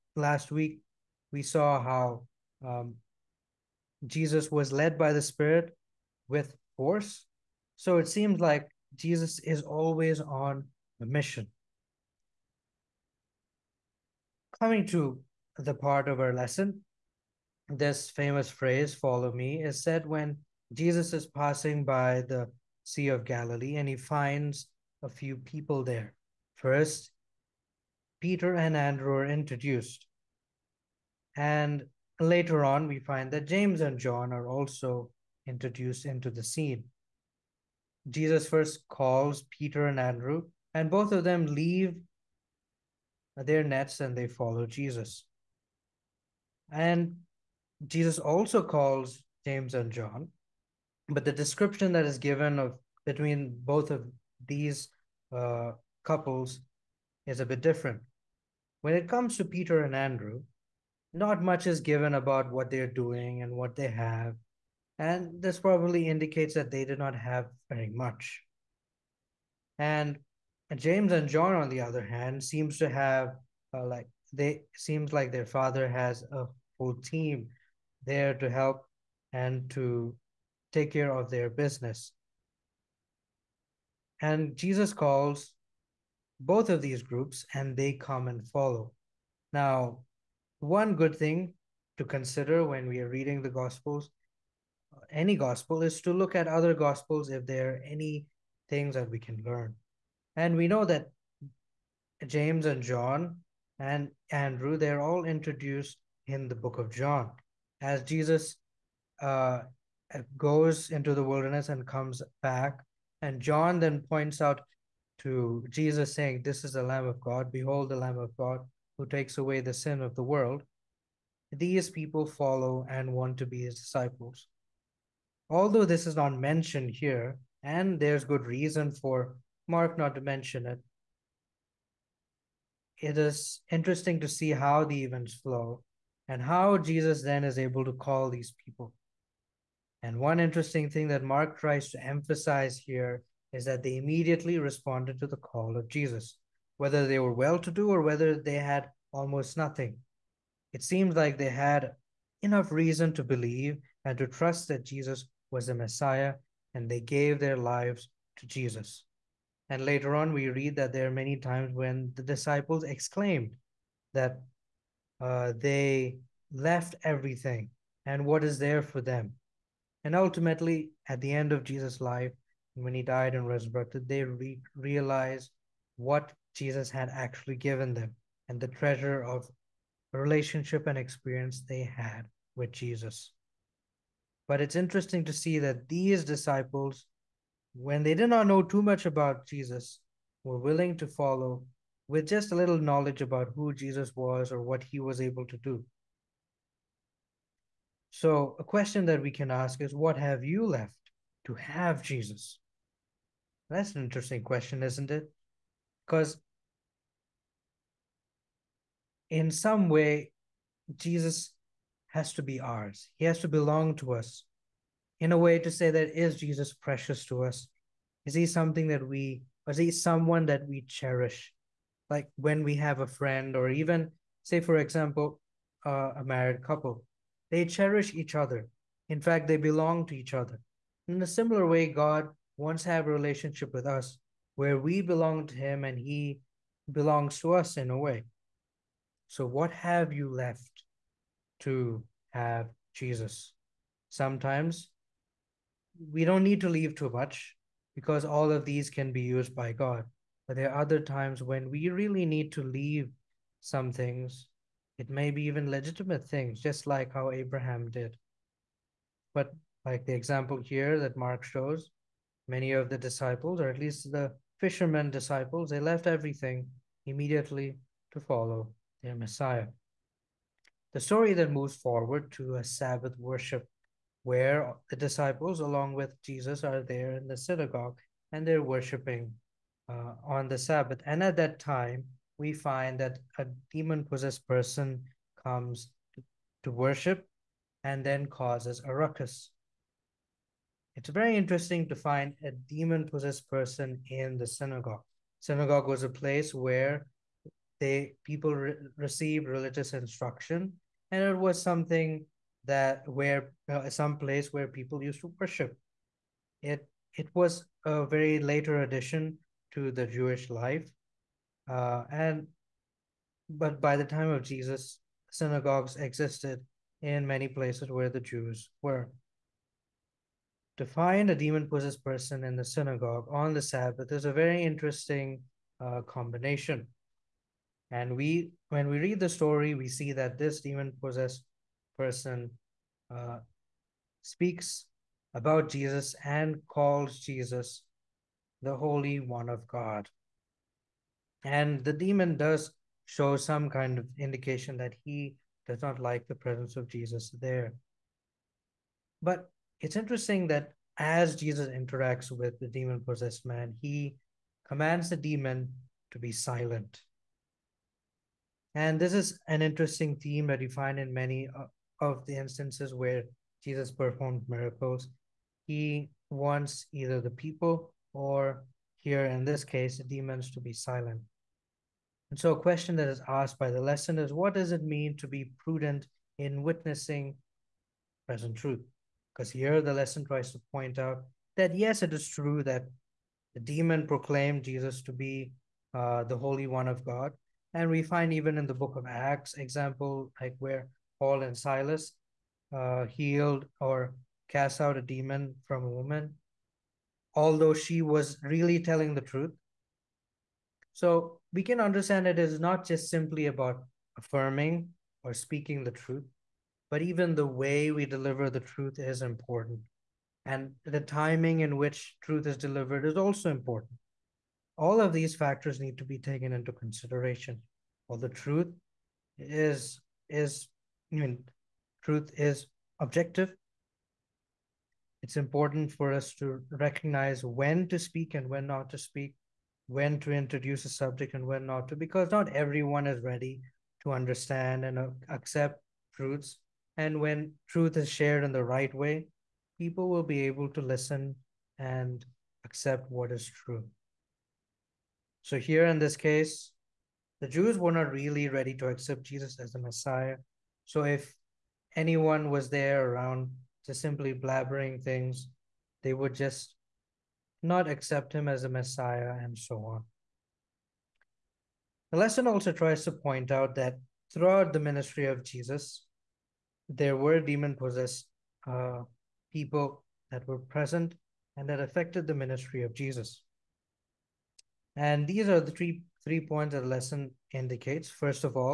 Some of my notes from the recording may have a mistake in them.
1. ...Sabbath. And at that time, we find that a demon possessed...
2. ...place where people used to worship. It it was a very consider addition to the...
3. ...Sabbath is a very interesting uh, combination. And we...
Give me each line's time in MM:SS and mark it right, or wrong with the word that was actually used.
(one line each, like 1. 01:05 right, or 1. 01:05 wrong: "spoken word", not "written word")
1. 04:40 right
2. 05:04 wrong: "later", not "consider"
3. 05:23 right.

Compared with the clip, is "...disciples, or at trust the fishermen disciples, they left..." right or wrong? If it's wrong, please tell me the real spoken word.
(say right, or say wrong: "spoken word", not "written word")
wrong: "least", not "trust".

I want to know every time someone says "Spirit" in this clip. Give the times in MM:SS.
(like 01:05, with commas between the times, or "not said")
00:05.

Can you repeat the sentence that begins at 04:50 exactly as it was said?
It's very interesting to find a demon possessed person in the synagogue.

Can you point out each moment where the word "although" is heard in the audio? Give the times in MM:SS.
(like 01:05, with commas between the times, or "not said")
02:05, 06:37.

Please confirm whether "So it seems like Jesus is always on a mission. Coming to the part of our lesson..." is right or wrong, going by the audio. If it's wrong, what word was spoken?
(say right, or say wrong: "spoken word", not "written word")
right.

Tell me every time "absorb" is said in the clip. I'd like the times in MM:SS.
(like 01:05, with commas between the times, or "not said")
not said.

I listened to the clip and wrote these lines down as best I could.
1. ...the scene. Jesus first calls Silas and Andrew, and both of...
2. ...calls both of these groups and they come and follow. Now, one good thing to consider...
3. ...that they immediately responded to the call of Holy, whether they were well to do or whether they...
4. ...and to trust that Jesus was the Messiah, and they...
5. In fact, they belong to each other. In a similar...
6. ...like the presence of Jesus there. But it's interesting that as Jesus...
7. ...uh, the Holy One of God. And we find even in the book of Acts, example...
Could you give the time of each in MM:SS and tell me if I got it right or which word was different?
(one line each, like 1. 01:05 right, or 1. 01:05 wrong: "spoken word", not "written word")
1. 00:36 wrong: "Peter", not "Silas"
2. 01:24 right
3. 02:23 wrong: "Jesus", not "Holy"
4. 02:34 right
5. 03:49 right
6. 05:45 right
7. 06:25 right.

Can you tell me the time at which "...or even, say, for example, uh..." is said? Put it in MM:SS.
03:43.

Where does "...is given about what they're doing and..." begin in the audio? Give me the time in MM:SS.
01:01.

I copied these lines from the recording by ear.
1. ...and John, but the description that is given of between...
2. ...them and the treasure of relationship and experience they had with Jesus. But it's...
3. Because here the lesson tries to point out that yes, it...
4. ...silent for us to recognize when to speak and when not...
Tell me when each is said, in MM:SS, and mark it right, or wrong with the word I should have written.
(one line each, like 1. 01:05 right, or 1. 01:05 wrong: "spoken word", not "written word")
1. 00:49 right
2. 02:57 right
3. 06:19 right
4. 07:05 wrong: "important", not "silent".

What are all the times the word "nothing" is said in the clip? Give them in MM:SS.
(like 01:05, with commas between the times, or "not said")
02:29.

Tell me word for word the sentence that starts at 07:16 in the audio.
And when truth is shared in the right way, people will be able to listen and accept what is true.